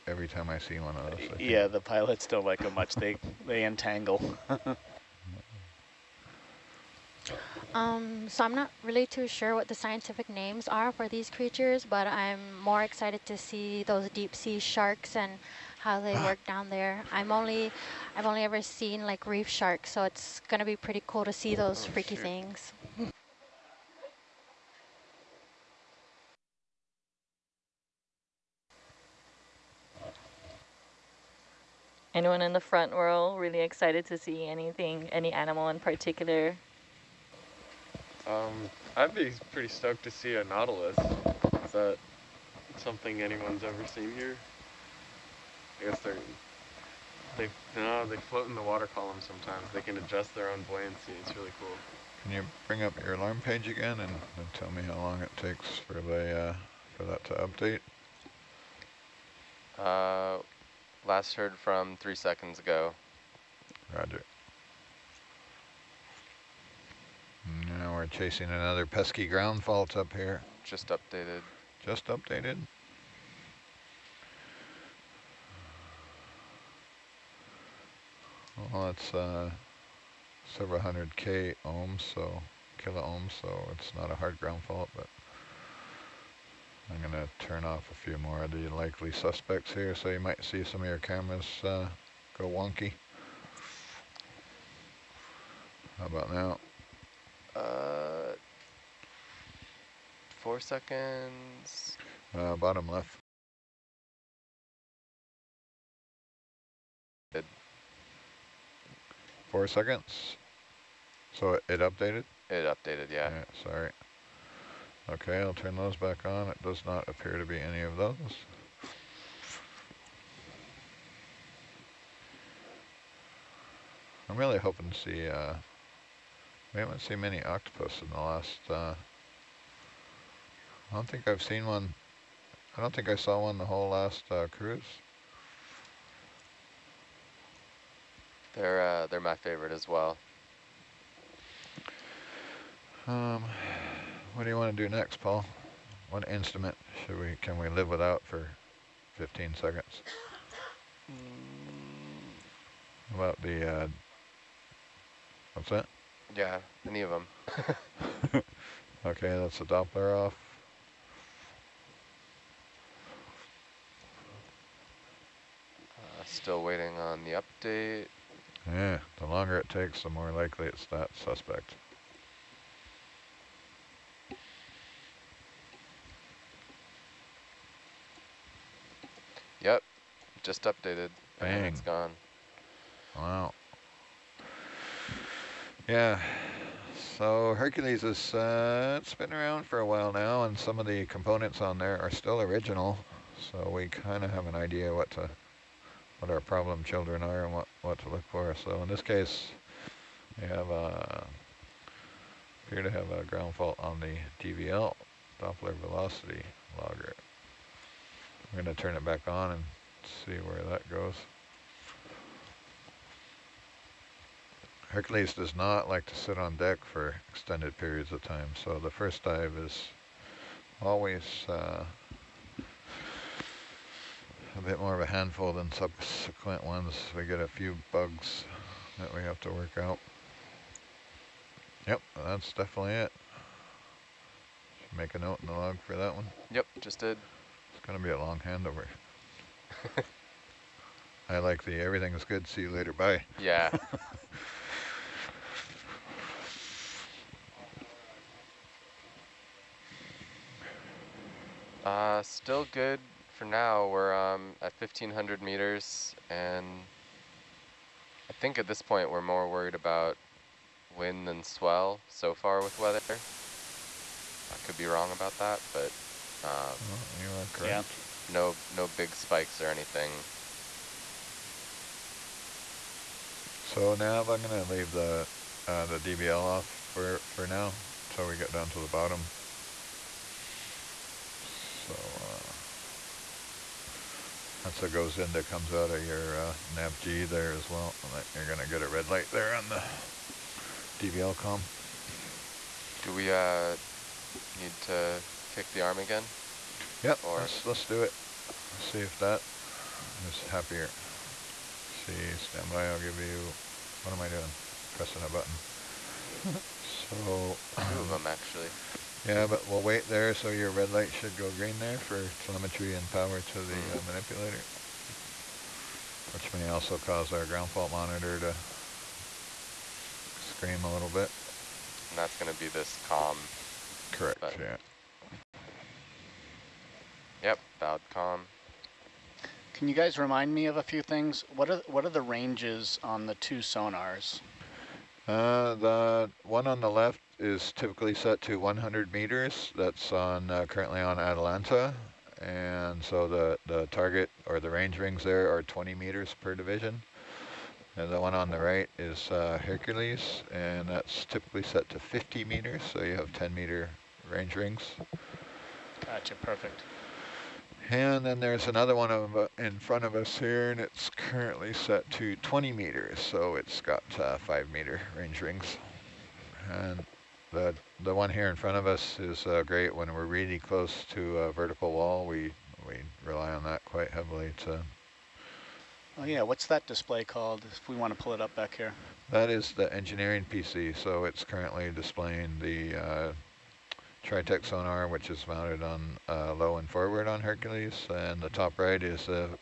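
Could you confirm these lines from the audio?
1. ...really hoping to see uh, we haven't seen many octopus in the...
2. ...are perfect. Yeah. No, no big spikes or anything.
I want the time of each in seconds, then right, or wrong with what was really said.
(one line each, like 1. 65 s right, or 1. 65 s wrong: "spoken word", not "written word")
1. 124 s right
2. 267 s wrong: "correct", not "perfect".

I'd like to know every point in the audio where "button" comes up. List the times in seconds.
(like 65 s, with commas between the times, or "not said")
305 s, 324 s.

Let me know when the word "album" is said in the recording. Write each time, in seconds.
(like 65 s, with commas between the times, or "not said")
not said.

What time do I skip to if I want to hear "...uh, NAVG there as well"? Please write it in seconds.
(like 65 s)
286 s.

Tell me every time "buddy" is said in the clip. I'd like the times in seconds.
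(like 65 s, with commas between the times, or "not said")
not said.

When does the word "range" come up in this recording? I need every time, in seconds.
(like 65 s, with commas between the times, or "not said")
332 s, 344 s, 354 s, 365 s.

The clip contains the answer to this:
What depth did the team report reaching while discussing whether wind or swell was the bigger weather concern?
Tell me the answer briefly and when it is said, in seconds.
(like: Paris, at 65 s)
1,500 meters, at 254 s.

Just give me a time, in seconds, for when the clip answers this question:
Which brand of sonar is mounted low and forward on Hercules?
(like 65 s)
384 s.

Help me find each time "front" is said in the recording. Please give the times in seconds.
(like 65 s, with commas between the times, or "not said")
32 s, 359 s, 368 s.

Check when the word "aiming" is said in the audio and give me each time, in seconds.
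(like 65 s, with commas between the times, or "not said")
not said.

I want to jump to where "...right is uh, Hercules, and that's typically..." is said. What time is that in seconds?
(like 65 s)
348 s.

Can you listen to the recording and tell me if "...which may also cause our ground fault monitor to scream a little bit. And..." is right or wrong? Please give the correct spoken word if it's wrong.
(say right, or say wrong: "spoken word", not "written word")
right.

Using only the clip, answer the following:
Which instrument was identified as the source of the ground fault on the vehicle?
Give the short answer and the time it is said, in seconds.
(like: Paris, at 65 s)
Doppler velocity logger, at 205 s.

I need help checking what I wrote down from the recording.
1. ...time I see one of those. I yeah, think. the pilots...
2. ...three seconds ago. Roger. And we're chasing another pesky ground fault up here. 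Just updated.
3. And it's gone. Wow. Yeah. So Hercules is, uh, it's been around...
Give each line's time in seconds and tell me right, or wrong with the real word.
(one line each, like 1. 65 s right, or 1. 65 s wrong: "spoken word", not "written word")
1. 0 s right
2. 61 s right
3. 181 s right.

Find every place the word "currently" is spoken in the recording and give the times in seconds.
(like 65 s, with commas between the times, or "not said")
340 s, 361 s, 381 s.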